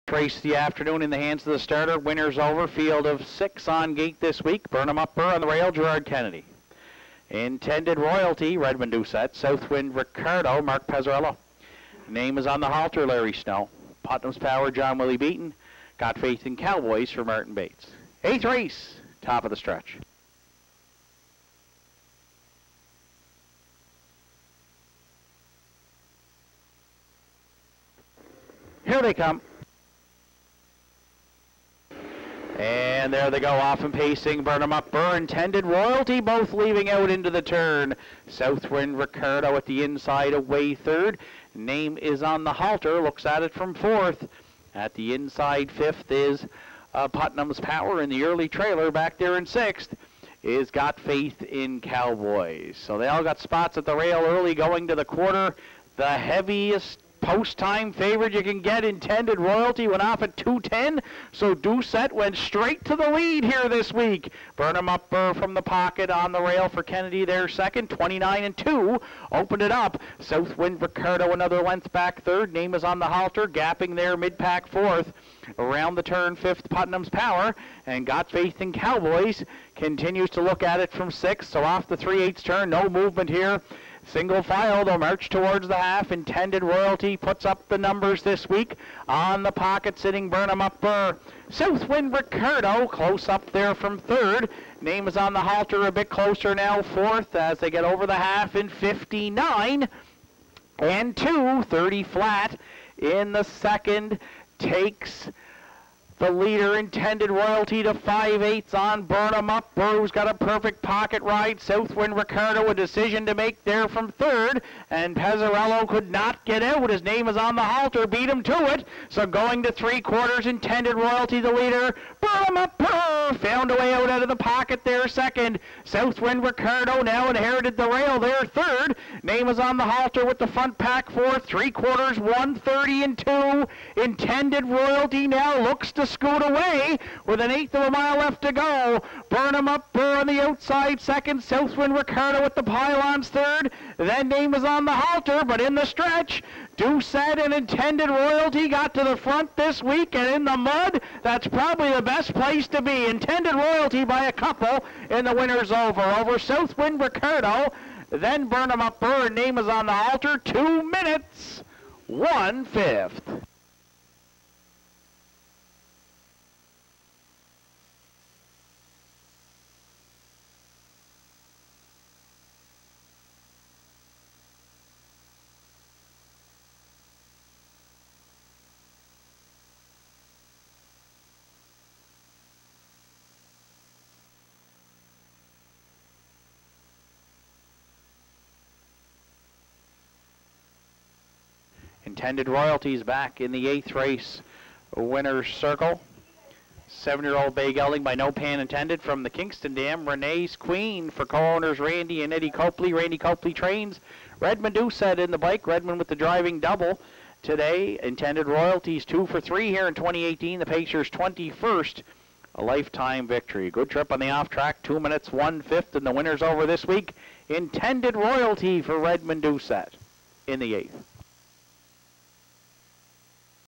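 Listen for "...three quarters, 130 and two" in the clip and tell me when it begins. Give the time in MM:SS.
02:11.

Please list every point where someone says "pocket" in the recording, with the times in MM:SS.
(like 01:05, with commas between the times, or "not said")
01:05, 01:29, 01:50, 02:04.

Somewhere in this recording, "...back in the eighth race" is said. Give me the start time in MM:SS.
03:13.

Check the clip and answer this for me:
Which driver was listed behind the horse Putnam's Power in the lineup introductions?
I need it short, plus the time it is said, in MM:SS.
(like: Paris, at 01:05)
John Willie Beaton, at 00:14.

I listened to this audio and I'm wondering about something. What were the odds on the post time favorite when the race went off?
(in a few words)
2.10.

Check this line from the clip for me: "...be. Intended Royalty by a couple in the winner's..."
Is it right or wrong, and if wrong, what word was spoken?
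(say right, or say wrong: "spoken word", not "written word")
right.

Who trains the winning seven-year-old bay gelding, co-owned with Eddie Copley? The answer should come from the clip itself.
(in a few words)
Randy Copley.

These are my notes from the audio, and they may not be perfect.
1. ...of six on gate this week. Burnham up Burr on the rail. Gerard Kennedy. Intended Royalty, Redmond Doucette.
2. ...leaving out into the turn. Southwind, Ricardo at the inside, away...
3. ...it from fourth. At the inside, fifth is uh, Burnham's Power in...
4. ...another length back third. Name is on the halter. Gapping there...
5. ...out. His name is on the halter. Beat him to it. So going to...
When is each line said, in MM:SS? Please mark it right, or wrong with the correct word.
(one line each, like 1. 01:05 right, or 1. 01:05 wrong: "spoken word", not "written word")
1. 00:03 right
2. 00:36 right
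3. 00:43 wrong: "Putnam", not "Burnham"
4. 01:11 right
5. 01:56 right.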